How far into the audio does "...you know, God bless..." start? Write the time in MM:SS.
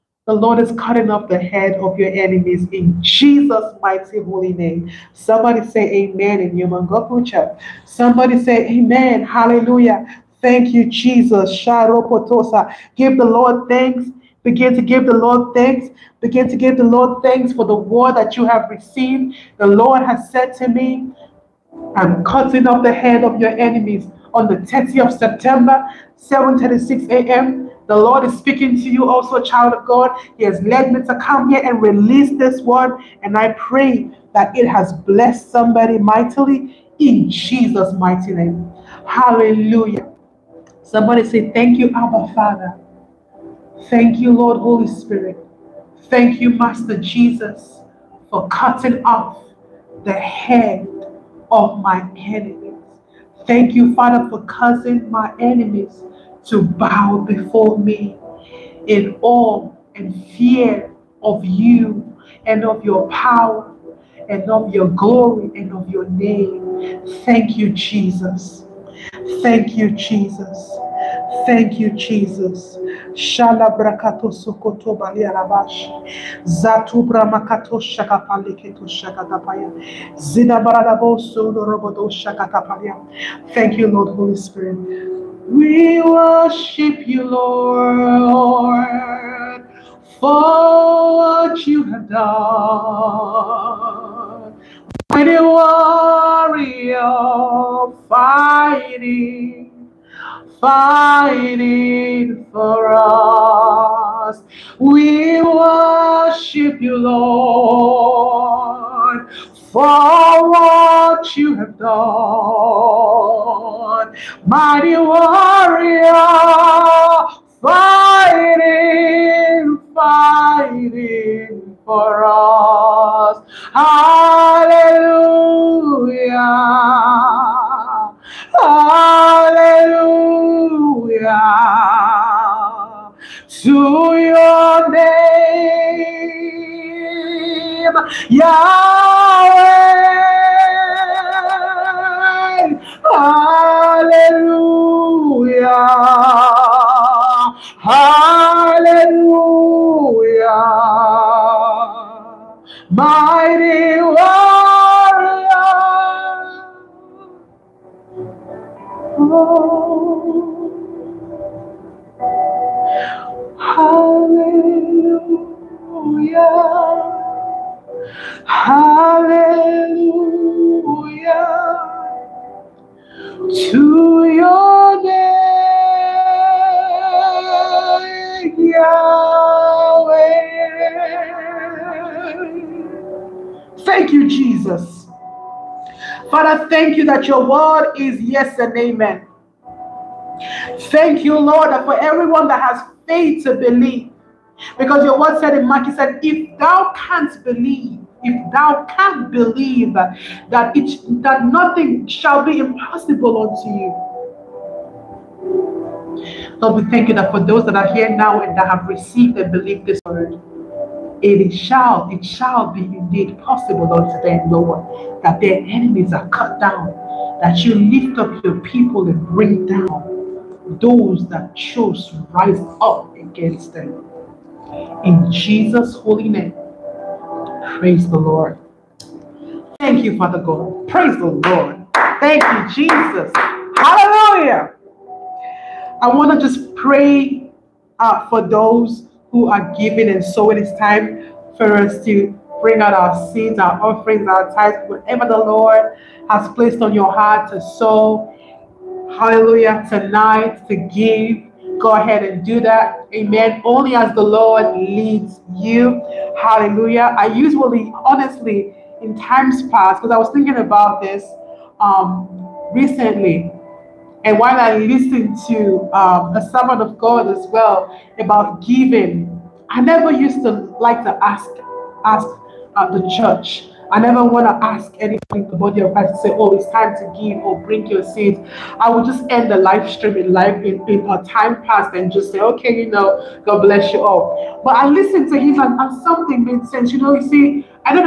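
04:42.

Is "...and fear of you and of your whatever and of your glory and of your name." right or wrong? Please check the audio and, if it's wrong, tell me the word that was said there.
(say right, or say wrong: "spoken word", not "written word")
wrong: "power", not "whatever".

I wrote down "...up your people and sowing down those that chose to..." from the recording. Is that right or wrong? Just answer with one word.
wrong.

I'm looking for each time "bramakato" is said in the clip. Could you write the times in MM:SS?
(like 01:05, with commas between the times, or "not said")
01:17.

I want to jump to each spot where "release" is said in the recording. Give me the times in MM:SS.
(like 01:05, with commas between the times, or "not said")
00:31.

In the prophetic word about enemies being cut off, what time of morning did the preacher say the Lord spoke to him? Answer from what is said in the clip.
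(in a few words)
7:36 a.m.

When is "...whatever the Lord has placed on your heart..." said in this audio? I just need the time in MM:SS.
04:04.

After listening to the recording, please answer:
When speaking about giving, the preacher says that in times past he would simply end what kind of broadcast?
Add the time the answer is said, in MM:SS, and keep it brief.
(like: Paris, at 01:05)
live stream, at 04:39.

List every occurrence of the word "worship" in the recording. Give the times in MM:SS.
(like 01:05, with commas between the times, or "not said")
01:26, 01:45.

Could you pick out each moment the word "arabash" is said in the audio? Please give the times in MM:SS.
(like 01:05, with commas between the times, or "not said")
01:15.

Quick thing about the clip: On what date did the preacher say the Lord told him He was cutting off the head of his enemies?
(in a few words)
30th of September.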